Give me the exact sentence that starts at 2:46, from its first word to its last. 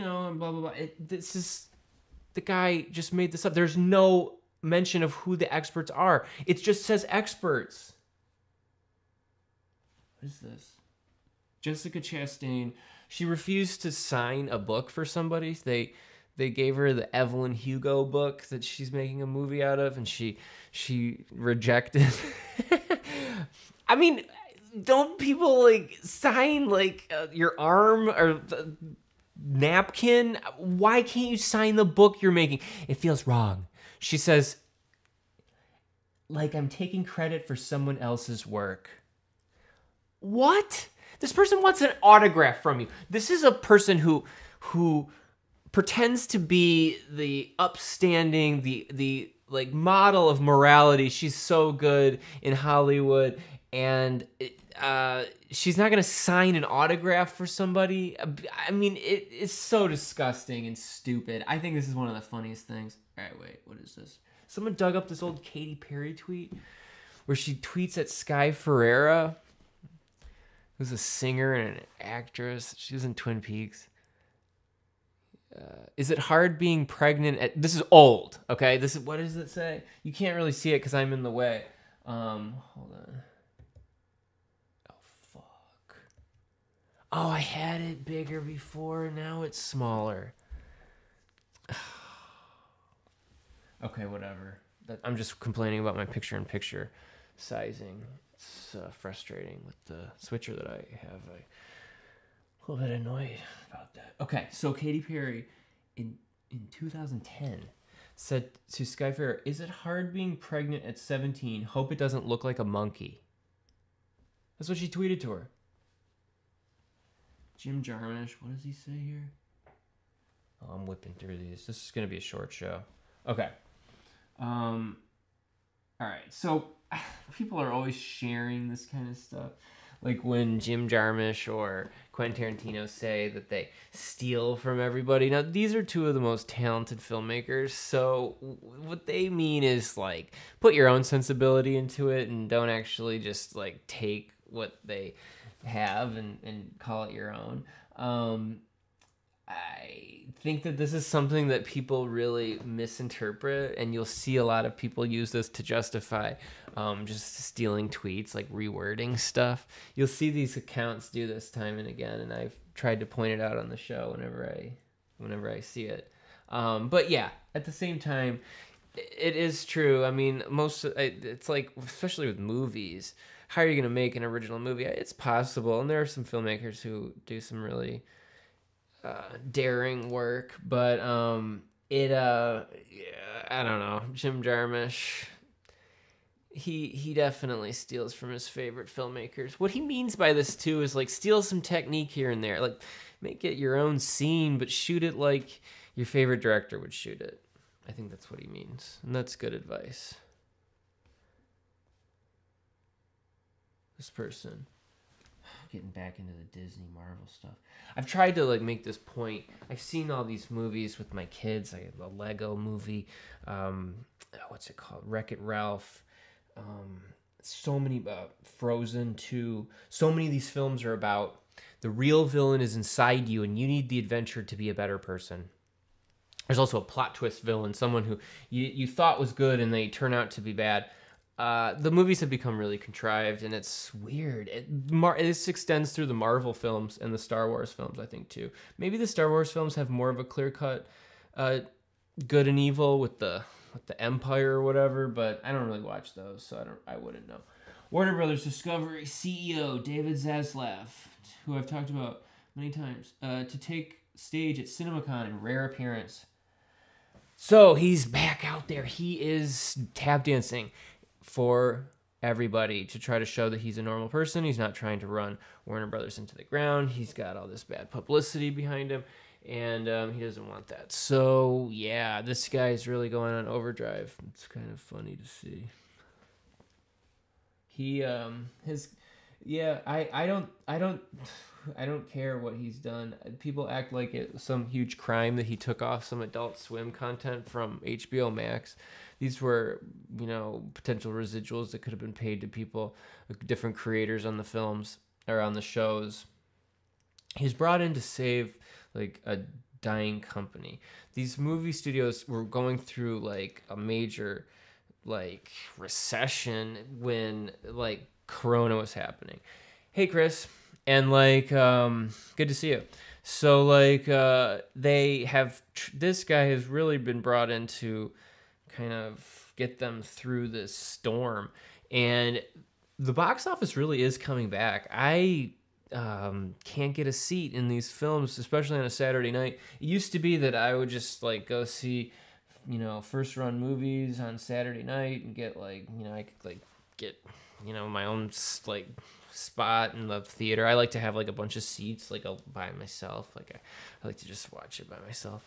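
Um, but yeah, at the same time, it is true.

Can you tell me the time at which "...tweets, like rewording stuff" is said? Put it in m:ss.
2:37.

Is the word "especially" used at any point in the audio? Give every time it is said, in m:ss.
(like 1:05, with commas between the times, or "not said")
2:51, 5:28.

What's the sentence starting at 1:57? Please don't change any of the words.
Jim Jarmusch, what does he say here?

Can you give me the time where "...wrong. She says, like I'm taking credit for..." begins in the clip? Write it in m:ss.
0:33.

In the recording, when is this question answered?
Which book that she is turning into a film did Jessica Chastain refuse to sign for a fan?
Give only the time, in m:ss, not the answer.
0:17.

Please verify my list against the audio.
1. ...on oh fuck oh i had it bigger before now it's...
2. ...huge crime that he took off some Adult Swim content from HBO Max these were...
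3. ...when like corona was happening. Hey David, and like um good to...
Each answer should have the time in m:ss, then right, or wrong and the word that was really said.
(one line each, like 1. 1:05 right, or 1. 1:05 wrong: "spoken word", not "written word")
1. 1:22 right
2. 4:44 right
3. 5:06 wrong: "Chris", not "David".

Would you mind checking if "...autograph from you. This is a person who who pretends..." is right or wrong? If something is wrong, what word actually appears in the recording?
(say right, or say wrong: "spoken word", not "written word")
right.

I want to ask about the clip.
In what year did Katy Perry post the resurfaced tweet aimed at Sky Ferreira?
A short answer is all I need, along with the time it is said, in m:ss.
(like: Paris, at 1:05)
2010, at 1:46.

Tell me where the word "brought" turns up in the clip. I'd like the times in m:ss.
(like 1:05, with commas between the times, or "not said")
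4:57, 5:17.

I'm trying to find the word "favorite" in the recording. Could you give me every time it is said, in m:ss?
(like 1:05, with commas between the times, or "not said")
3:08, 3:16.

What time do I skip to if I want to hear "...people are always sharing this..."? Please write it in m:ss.
2:07.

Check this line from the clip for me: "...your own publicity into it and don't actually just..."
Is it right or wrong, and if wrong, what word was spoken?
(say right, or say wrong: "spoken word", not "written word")
wrong: "sensibility", not "publicity".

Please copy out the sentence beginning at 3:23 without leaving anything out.
This person getting back into the Disney Marvel stuff.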